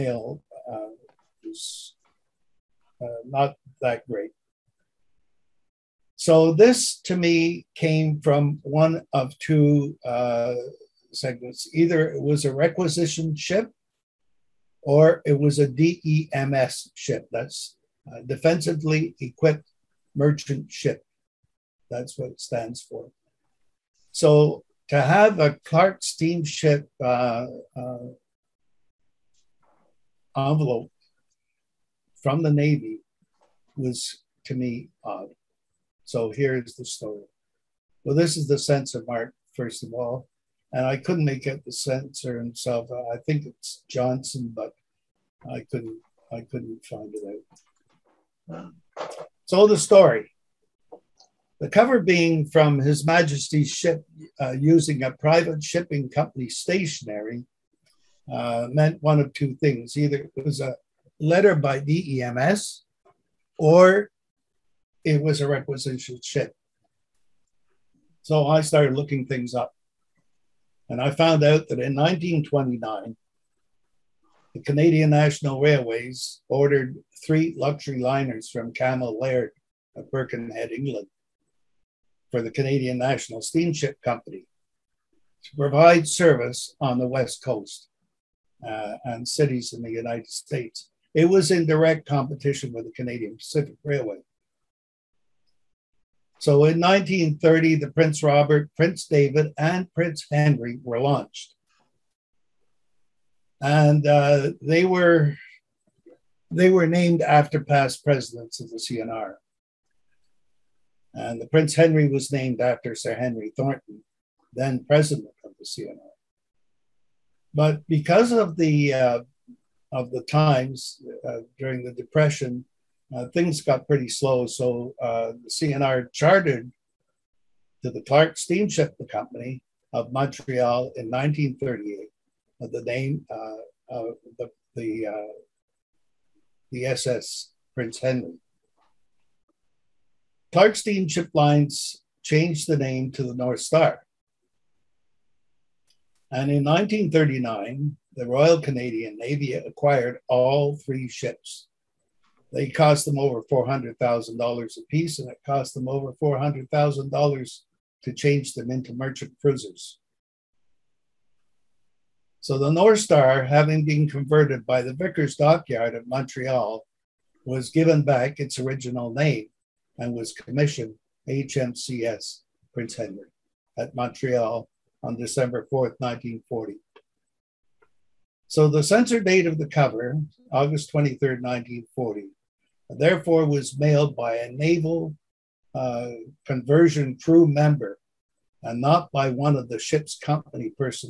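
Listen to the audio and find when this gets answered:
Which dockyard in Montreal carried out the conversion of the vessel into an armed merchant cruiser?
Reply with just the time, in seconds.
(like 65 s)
164 s.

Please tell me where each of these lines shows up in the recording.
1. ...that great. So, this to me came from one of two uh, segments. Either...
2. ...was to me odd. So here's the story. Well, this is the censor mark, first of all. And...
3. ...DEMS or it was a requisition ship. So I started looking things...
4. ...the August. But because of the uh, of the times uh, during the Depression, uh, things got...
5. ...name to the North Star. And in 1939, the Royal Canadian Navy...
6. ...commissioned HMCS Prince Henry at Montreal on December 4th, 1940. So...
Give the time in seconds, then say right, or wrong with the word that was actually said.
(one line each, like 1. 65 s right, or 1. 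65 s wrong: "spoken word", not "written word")
1. 3 s right
2. 33 s right
3. 61 s right
4. 115 s wrong: "CNR", not "August"
5. 142 s right
6. 170 s right.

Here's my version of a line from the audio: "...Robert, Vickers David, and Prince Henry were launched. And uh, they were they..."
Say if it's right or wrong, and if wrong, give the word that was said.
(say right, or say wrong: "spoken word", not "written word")
wrong: "Prince", not "Vickers".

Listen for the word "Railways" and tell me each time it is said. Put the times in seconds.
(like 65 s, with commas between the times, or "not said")
75 s, 93 s.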